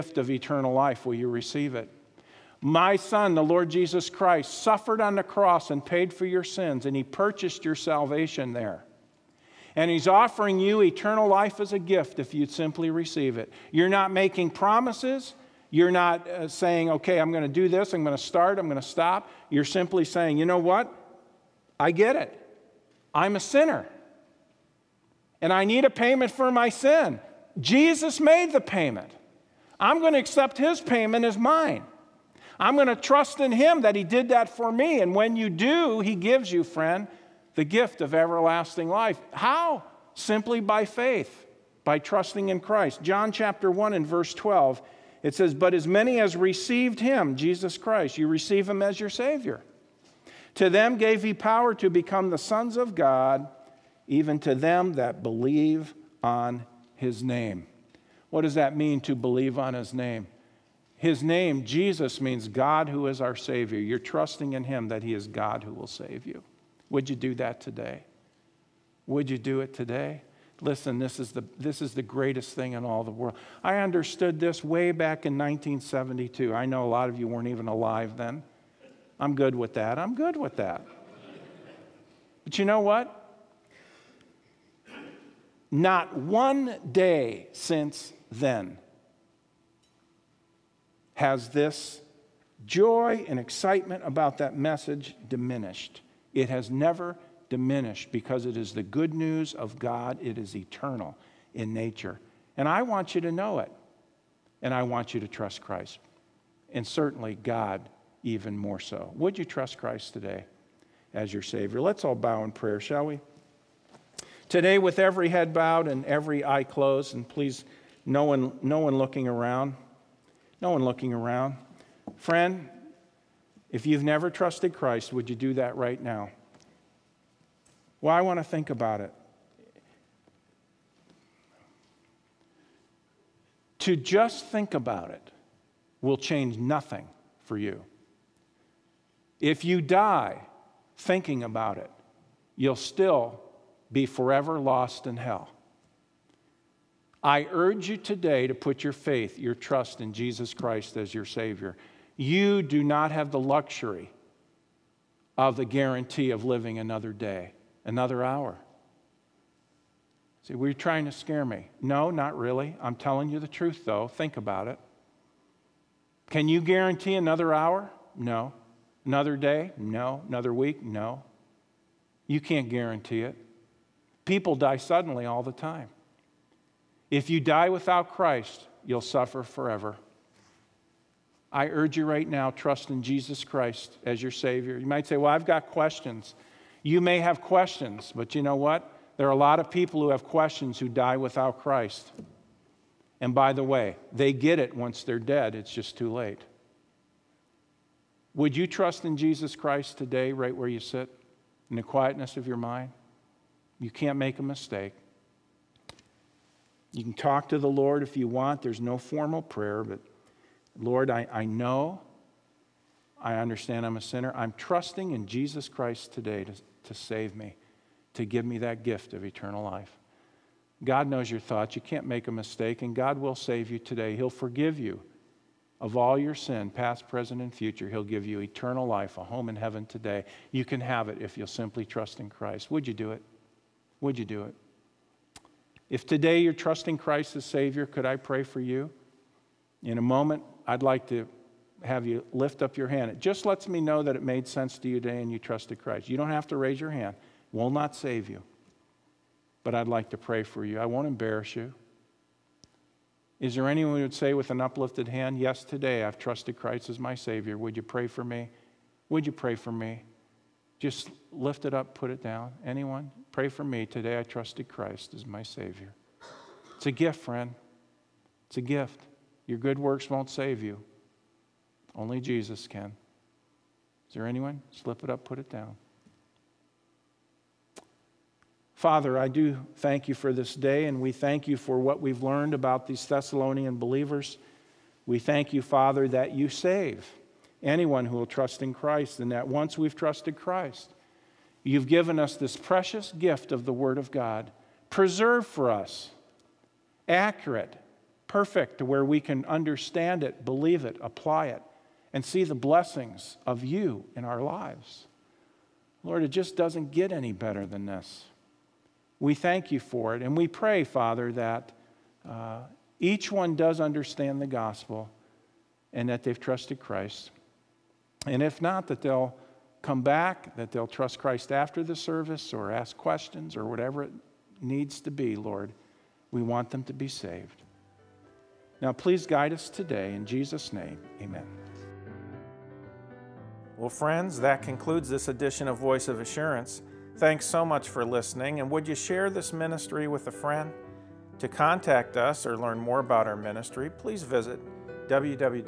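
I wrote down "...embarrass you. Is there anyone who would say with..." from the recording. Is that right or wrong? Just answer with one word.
right.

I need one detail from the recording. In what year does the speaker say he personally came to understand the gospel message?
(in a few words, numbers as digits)
1972.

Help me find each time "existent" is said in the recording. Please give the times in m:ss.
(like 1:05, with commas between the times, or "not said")
not said.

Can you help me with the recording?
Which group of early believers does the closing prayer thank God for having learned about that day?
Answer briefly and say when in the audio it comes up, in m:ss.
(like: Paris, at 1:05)
Thessalonian believers, at 4:43.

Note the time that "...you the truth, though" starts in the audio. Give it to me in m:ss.
2:43.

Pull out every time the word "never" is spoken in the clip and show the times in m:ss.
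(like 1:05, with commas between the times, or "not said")
1:36, 2:04.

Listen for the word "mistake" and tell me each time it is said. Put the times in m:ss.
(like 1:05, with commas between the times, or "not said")
3:24, 3:42.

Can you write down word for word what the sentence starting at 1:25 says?
Not one day since then has this joy and excitement about that message diminished.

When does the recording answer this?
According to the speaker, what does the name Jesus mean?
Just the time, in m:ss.
1:02.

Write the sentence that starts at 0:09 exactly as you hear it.
And he's offering you eternal life as a gift if you'd simply receive it.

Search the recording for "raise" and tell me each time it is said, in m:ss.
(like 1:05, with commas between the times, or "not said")
4:06.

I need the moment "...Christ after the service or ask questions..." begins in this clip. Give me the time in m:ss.
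5:21.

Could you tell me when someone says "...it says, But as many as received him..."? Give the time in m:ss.
0:45.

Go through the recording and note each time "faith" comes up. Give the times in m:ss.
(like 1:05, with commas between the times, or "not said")
0:40, 2:28.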